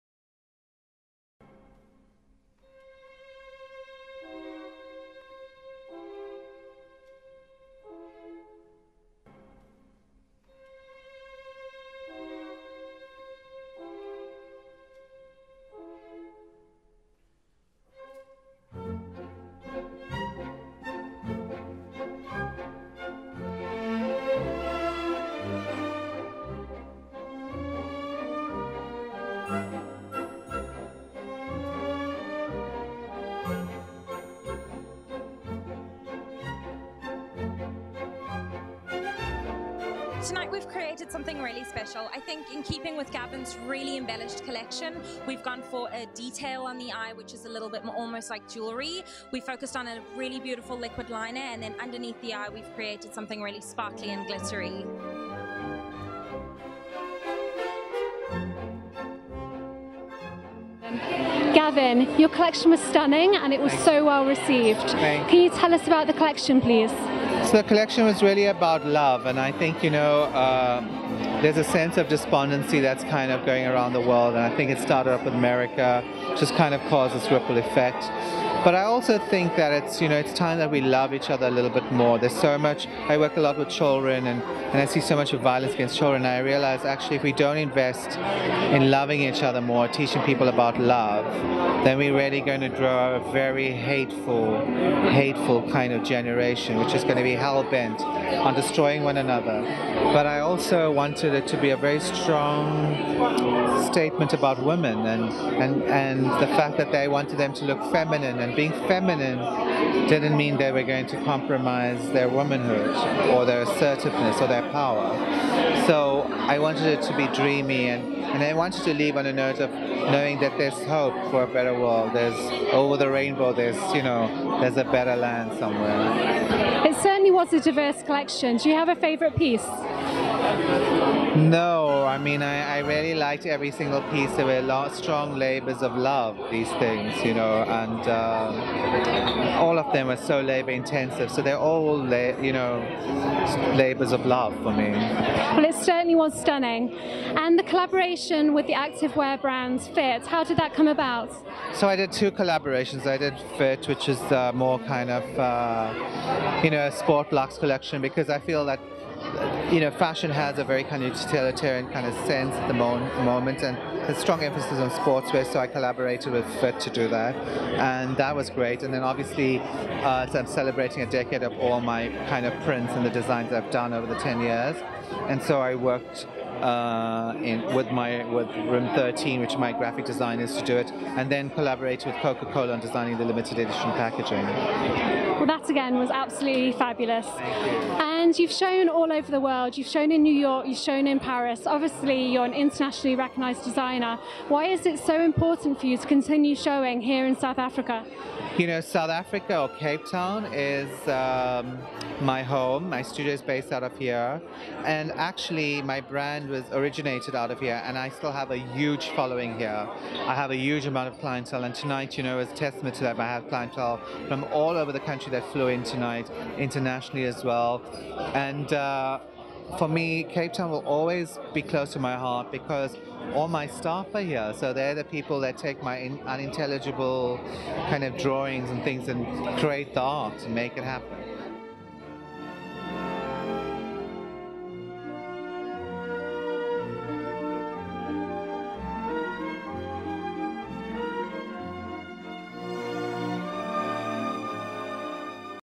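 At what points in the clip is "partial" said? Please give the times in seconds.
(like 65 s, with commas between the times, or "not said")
not said.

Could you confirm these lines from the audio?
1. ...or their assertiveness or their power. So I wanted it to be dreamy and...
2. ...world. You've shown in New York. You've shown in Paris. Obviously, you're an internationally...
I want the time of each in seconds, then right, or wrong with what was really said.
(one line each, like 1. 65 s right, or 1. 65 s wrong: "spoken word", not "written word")
1. 113 s right
2. 189 s right.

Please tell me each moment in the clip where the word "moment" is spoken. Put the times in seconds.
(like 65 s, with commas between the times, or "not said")
162 s.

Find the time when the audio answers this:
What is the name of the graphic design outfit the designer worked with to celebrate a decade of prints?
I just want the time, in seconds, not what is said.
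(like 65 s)
178 s.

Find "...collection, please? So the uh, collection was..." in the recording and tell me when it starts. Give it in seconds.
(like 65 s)
66 s.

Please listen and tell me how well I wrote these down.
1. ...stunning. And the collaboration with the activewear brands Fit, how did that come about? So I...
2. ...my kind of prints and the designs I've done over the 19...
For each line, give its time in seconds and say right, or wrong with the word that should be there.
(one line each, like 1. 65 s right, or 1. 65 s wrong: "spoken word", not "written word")
1. 146 s right
2. 171 s wrong: "10", not "19".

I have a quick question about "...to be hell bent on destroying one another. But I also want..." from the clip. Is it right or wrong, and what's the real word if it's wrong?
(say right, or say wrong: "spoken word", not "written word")
right.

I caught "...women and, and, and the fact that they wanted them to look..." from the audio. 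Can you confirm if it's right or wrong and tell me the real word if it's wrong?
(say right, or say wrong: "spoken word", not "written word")
right.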